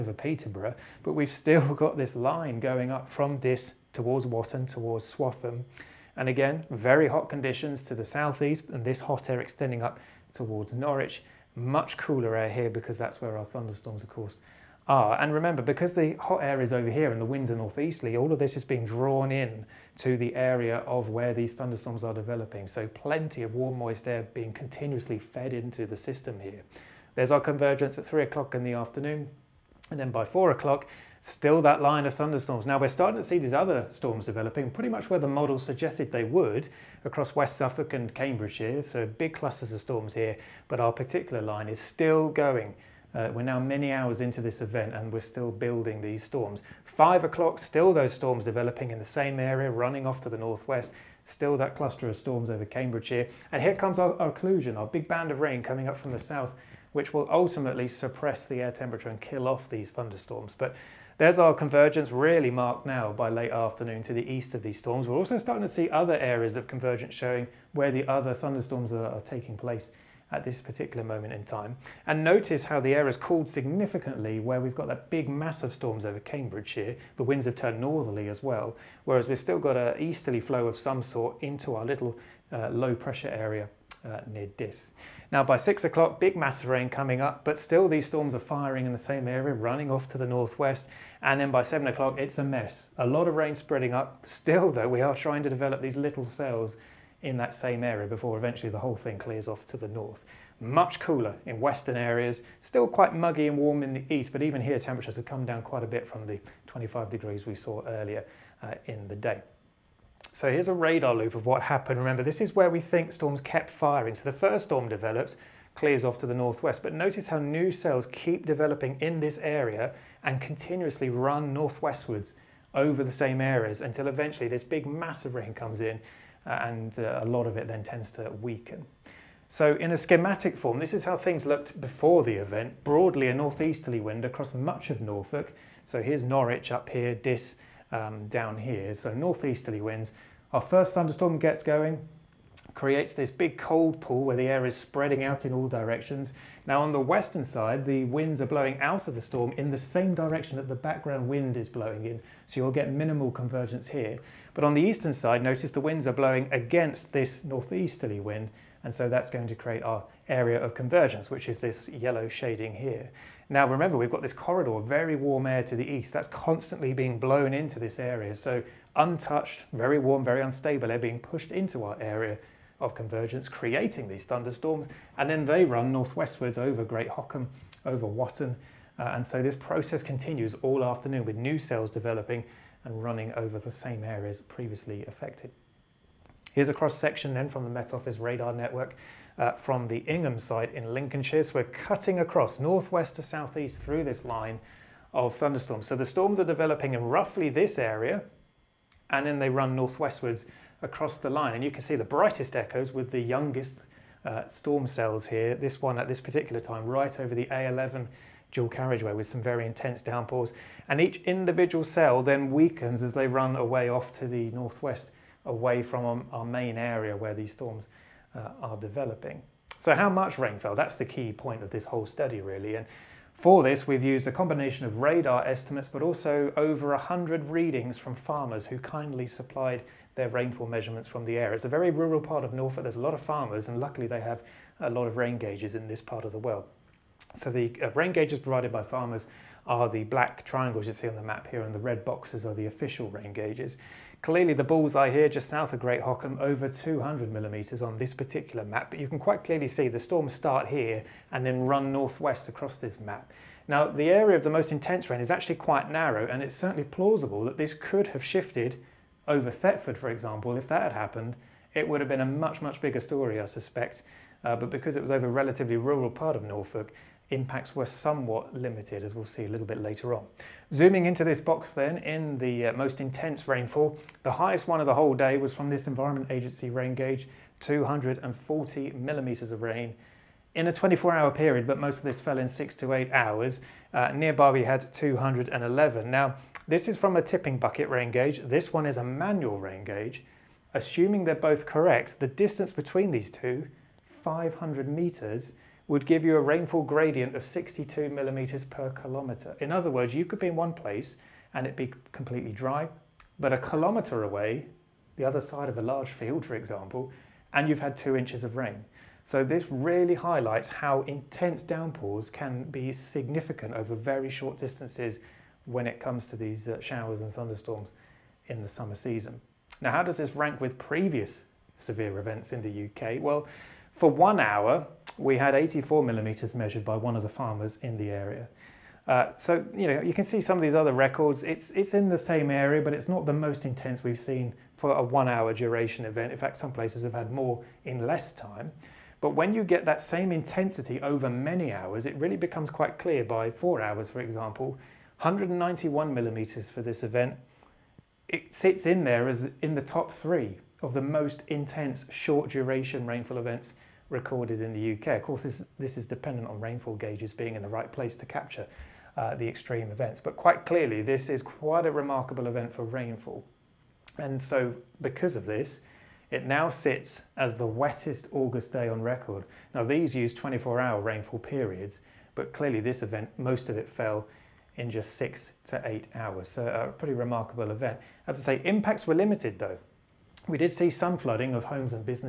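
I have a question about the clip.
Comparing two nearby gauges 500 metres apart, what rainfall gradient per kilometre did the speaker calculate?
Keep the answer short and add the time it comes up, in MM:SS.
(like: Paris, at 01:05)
62 millimetres per kilometre, at 04:57.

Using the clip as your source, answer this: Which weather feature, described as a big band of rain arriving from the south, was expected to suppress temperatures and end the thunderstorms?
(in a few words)
occlusion.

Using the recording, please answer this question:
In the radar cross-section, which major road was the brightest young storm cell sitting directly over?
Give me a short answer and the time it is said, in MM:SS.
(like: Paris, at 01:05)
A11, at 03:27.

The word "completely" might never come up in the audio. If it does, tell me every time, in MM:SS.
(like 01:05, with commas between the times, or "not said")
05:02.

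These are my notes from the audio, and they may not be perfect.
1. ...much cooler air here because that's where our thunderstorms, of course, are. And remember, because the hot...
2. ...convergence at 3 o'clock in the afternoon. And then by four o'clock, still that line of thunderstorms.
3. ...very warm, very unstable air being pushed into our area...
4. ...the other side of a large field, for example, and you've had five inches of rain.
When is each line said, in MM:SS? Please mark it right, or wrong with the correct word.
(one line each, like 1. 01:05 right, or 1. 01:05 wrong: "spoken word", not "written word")
1. 00:11 right
2. 00:27 right
3. 02:49 right
4. 05:05 wrong: "two", not "five".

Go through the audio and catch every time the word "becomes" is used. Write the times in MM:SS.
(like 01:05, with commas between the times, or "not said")
05:42.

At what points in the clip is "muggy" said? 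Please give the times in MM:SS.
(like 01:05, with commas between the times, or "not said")
01:43.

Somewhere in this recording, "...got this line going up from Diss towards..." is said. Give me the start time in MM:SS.
00:01.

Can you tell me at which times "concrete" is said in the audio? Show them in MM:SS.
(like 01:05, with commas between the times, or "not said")
not said.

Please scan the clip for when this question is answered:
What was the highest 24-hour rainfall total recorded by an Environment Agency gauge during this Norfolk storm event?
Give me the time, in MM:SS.
04:37.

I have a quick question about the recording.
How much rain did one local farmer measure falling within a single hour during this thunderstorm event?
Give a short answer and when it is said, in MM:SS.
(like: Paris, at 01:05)
84 millimetres, at 05:25.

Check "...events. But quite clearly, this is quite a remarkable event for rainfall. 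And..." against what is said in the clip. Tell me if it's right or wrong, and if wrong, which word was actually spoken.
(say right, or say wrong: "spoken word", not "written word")
right.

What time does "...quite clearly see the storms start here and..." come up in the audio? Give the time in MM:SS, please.
04:09.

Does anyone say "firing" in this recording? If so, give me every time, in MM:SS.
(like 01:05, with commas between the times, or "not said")
01:28, 01:53.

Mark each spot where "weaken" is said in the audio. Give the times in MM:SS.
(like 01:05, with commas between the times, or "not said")
02:08, 03:32.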